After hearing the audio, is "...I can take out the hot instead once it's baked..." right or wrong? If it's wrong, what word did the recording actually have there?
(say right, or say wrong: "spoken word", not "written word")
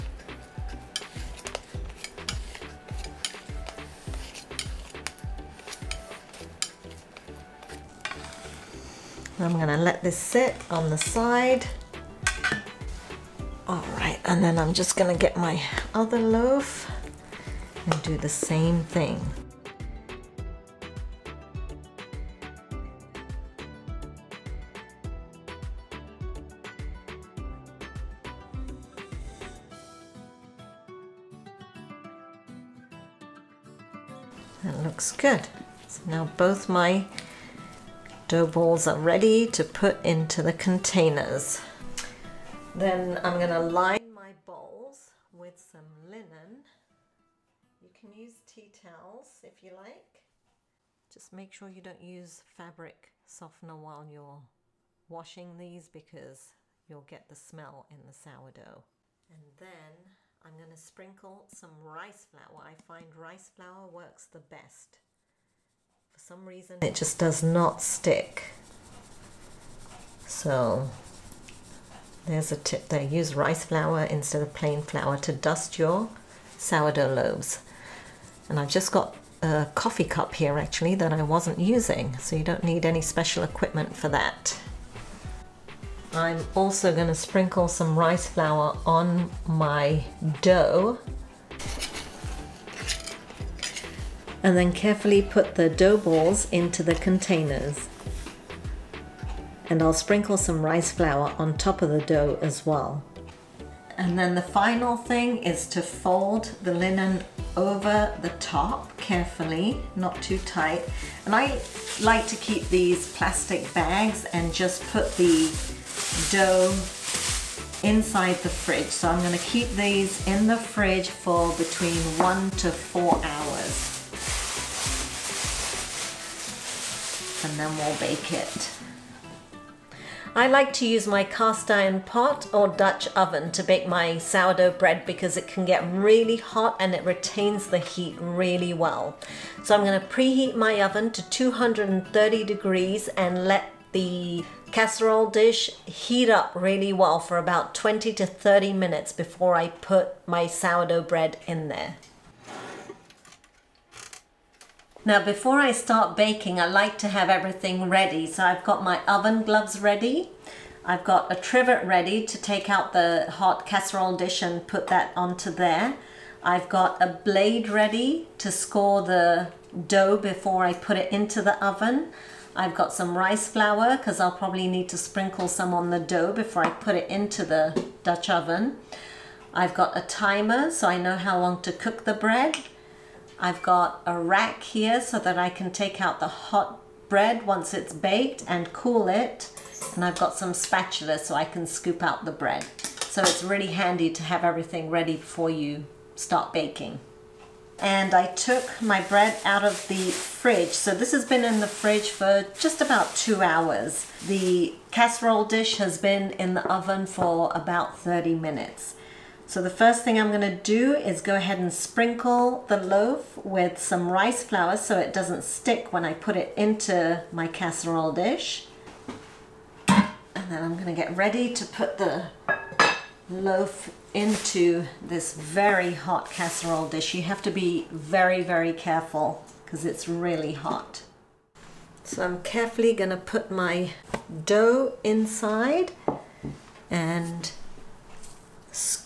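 wrong: "bread", not "instead".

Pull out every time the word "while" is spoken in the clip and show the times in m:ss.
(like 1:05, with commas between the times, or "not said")
0:53.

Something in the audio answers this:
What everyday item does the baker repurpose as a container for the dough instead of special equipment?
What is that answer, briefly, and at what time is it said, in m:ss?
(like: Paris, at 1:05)
coffee cup, at 1:19.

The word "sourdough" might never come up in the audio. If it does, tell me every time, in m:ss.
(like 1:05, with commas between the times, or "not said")
0:58, 1:16, 2:14, 2:30.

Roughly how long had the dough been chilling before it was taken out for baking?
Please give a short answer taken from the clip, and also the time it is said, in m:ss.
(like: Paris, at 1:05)
about 2 hours, at 3:22.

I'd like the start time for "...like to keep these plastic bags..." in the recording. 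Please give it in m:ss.
1:52.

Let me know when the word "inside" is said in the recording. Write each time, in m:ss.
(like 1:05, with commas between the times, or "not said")
1:57, 3:55.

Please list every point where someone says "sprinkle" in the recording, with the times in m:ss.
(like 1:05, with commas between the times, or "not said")
1:00, 1:27, 1:39, 2:54, 3:31.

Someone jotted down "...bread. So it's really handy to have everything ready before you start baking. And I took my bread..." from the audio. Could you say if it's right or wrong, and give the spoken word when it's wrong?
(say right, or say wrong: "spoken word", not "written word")
right.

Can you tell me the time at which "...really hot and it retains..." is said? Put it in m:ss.
2:15.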